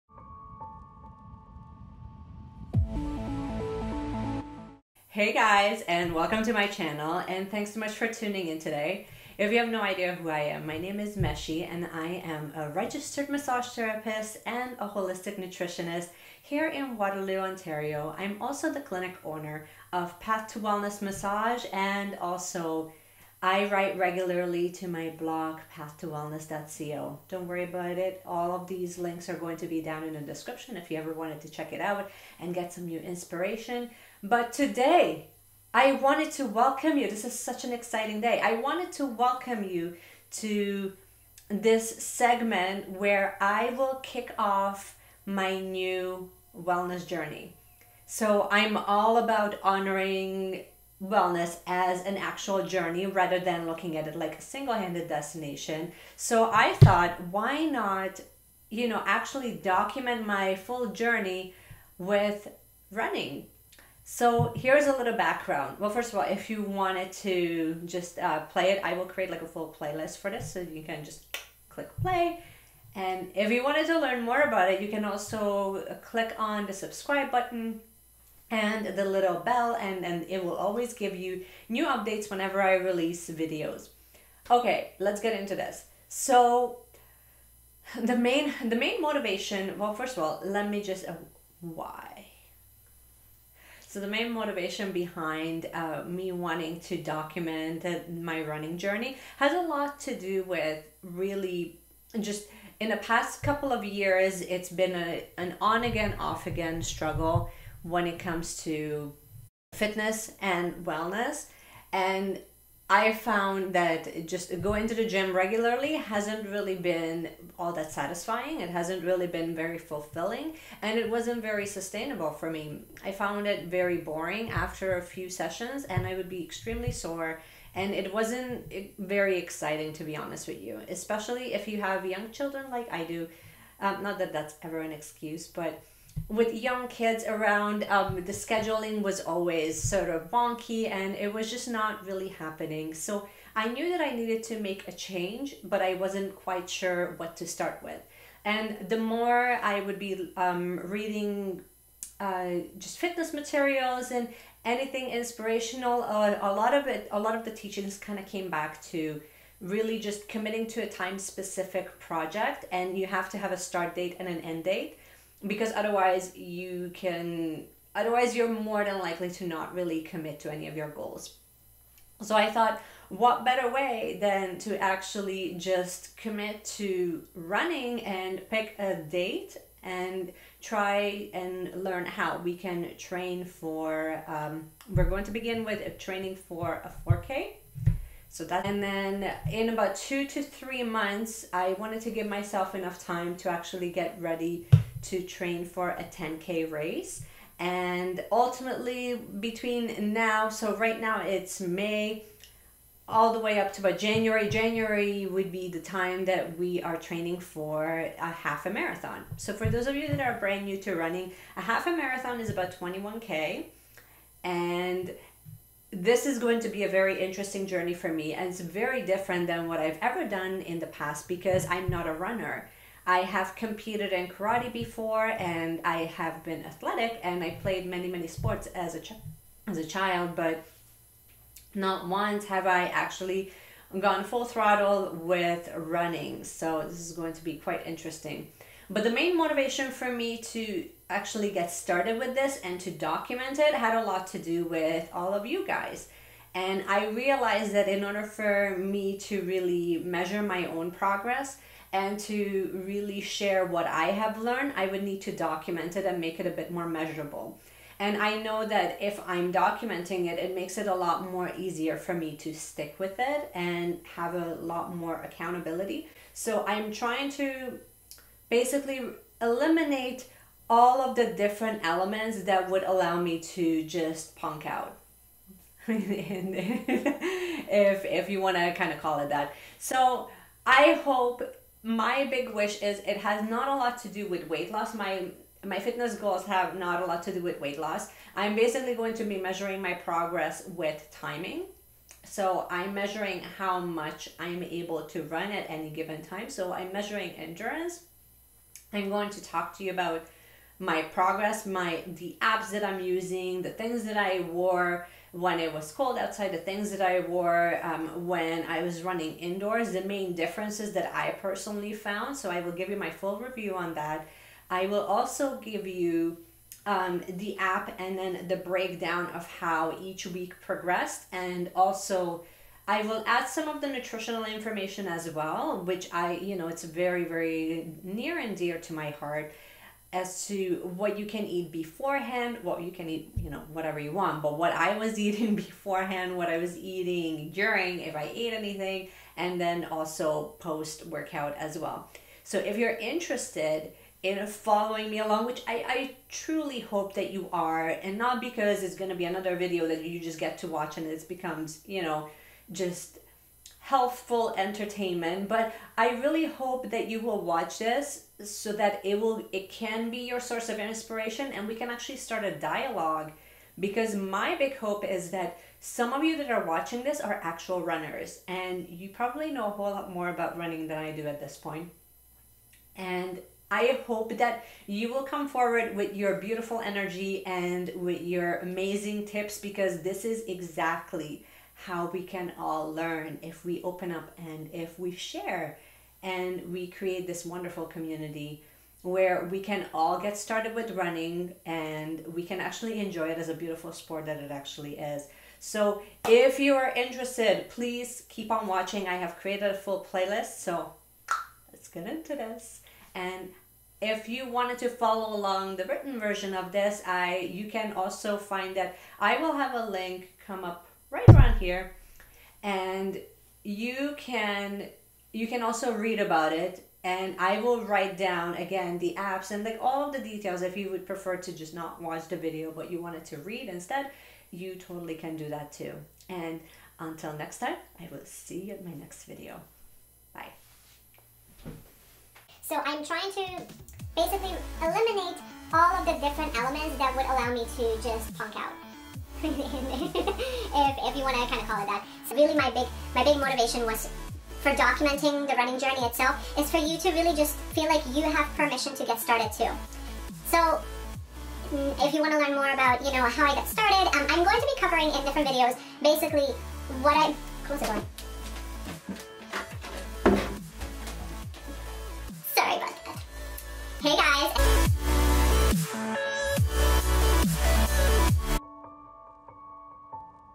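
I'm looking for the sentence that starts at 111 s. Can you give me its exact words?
And I found that just going to the gym regularly hasn't really been all that satisfying.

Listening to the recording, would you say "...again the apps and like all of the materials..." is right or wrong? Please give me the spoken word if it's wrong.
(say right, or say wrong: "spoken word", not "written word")
wrong: "details", not "materials".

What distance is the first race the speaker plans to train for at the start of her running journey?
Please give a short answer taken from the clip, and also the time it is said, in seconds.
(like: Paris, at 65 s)
4K, at 187 s.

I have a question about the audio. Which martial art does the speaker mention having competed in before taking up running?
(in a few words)
Karate.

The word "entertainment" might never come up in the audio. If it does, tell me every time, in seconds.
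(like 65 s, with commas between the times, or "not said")
354 s.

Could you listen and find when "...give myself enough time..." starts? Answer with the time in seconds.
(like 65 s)
192 s.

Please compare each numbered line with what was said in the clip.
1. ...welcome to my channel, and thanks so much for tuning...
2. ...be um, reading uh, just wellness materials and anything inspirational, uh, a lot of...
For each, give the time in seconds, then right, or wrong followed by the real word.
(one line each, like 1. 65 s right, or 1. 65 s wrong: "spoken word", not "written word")
1. 6 s right
2. 149 s wrong: "fitness", not "wellness".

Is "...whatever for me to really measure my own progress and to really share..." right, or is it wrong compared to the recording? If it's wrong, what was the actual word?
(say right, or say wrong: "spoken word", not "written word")
wrong: "order", not "whatever".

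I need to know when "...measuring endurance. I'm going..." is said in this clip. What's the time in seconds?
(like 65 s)
296 s.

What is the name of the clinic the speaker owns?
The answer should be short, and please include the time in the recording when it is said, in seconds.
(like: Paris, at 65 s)
Path to Wellness Massage, at 20 s.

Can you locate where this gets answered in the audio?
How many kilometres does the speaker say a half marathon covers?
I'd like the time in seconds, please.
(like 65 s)
212 s.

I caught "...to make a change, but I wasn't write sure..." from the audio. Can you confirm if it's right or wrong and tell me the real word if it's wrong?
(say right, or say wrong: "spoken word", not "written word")
wrong: "quite", not "write".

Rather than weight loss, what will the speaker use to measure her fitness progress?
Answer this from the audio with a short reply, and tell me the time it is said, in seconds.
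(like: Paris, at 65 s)
Timing, at 291 s.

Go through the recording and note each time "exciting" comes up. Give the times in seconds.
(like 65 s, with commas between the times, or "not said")
37 s, 129 s.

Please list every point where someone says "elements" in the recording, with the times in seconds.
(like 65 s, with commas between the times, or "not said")
271 s, 436 s.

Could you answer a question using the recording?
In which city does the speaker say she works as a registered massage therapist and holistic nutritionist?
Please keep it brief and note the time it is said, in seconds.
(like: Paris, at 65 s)
Waterloo, Ontario, at 16 s.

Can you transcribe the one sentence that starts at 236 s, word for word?
So this is going to be quite interesting.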